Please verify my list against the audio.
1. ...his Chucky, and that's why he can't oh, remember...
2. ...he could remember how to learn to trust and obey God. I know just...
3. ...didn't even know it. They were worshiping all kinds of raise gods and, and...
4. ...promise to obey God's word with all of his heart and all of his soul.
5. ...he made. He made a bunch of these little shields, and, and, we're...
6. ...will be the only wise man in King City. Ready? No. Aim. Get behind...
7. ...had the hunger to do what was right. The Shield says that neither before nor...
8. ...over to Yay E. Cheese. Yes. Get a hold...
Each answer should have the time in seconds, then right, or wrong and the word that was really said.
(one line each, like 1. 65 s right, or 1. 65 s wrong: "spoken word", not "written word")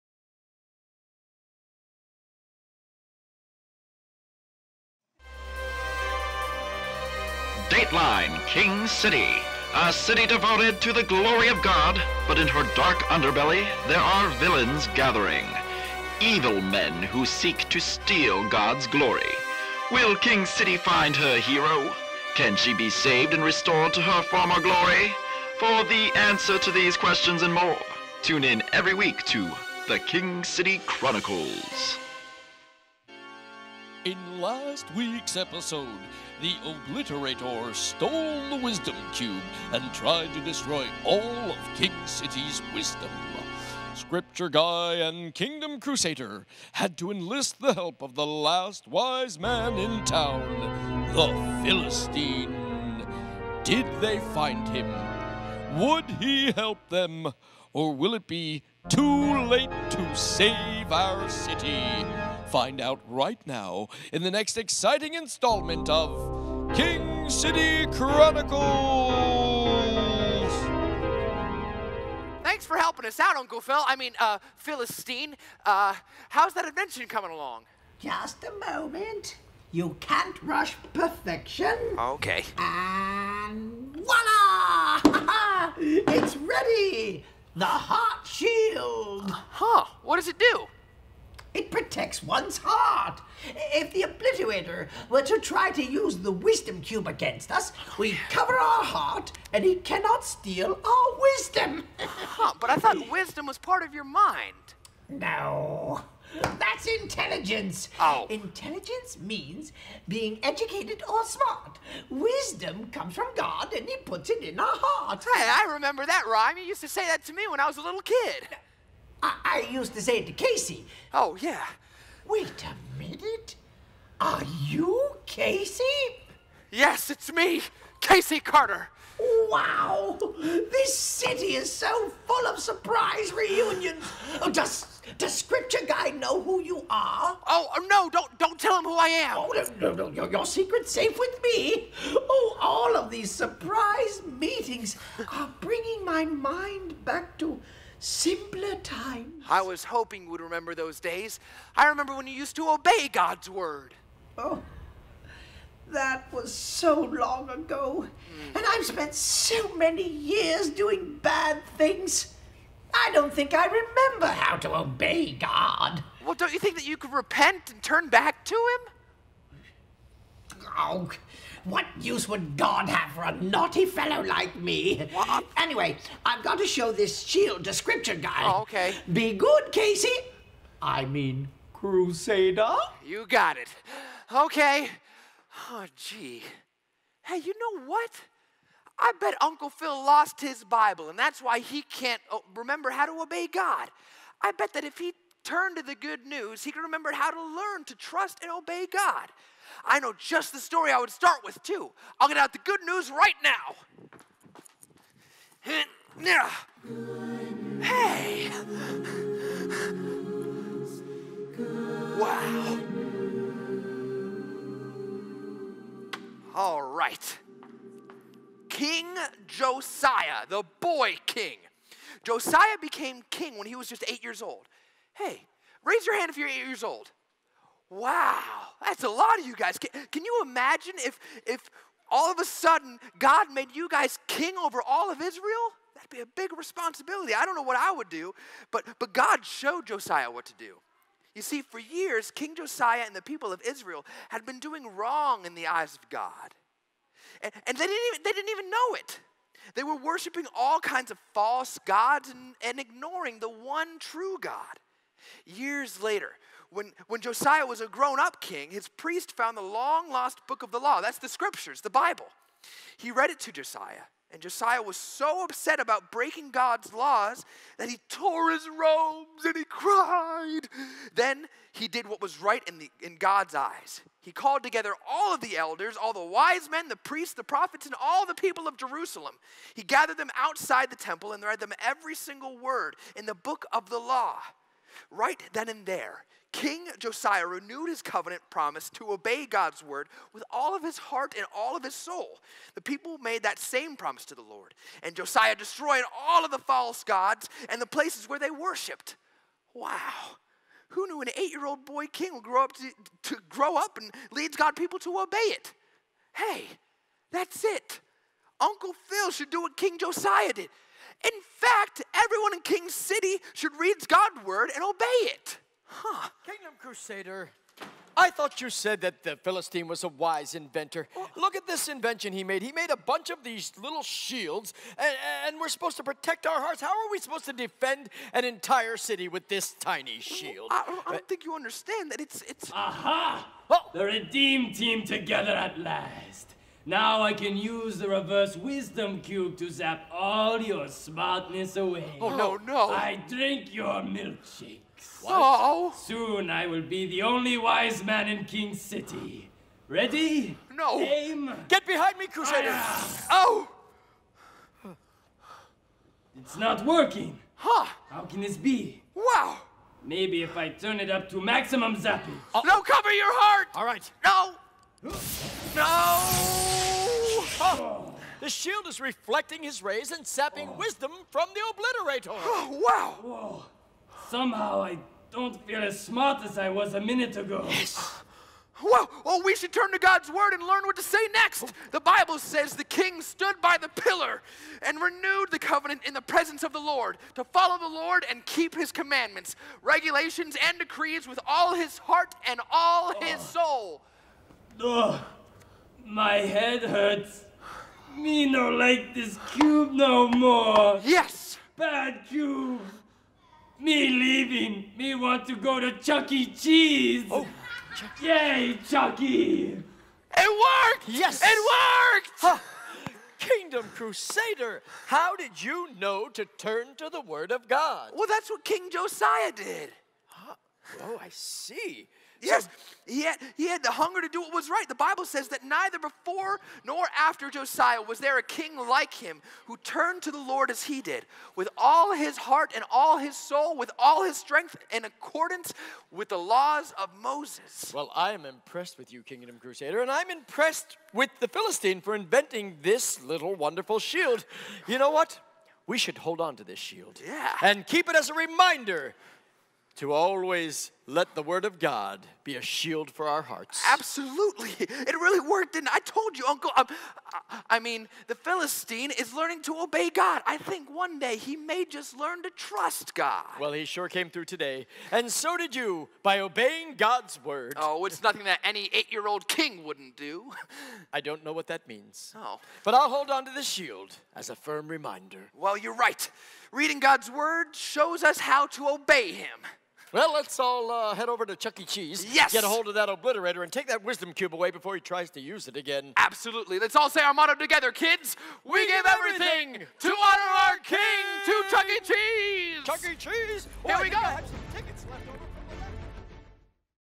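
1. 190 s wrong: "Bible", not "Chucky"
2. 196 s right
3. 248 s wrong: "false", not "raise"
4. 288 s right
5. 322 s right
6. 346 s right
7. 423 s wrong: "Bible", not "Shield"
8. 481 s wrong: "Chuck", not "Yay".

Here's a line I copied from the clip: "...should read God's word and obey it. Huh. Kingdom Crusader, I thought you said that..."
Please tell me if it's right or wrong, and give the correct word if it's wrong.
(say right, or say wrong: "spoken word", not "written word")
right.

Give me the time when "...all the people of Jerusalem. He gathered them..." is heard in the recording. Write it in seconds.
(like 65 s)
278 s.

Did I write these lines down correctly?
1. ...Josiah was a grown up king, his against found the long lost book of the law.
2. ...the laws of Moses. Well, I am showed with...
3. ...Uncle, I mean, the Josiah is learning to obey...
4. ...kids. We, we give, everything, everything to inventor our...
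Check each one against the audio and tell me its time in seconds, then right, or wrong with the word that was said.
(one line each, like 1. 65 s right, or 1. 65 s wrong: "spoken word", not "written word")
1. 257 s wrong: "priest", not "against"
2. 436 s wrong: "impressed", not "showed"
3. 456 s wrong: "Philistine", not "Josiah"
4. 487 s wrong: "honor", not "inventor".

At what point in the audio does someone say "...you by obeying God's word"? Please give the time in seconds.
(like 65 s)
465 s.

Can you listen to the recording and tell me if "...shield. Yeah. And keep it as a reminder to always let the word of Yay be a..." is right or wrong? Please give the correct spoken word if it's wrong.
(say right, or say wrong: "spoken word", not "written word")
wrong: "God", not "Yay".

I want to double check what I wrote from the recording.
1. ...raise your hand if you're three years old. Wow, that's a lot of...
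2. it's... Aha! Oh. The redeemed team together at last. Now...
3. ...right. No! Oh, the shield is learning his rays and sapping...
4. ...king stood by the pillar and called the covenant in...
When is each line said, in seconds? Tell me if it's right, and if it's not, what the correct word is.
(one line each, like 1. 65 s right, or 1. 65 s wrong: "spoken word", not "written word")
1. 225 s wrong: "eight", not "three"
2. 332 s right
3. 363 s wrong: "reflecting", not "learning"
4. 382 s wrong: "renewed", not "called".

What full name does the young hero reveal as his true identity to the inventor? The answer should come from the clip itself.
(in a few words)
Casey Carter.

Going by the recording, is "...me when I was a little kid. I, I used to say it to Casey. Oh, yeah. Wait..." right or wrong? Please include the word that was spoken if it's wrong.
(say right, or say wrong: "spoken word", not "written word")
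right.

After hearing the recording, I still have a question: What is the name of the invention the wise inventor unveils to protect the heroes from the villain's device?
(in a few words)
The Heart Shield.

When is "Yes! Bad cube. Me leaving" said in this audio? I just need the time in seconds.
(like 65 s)
401 s.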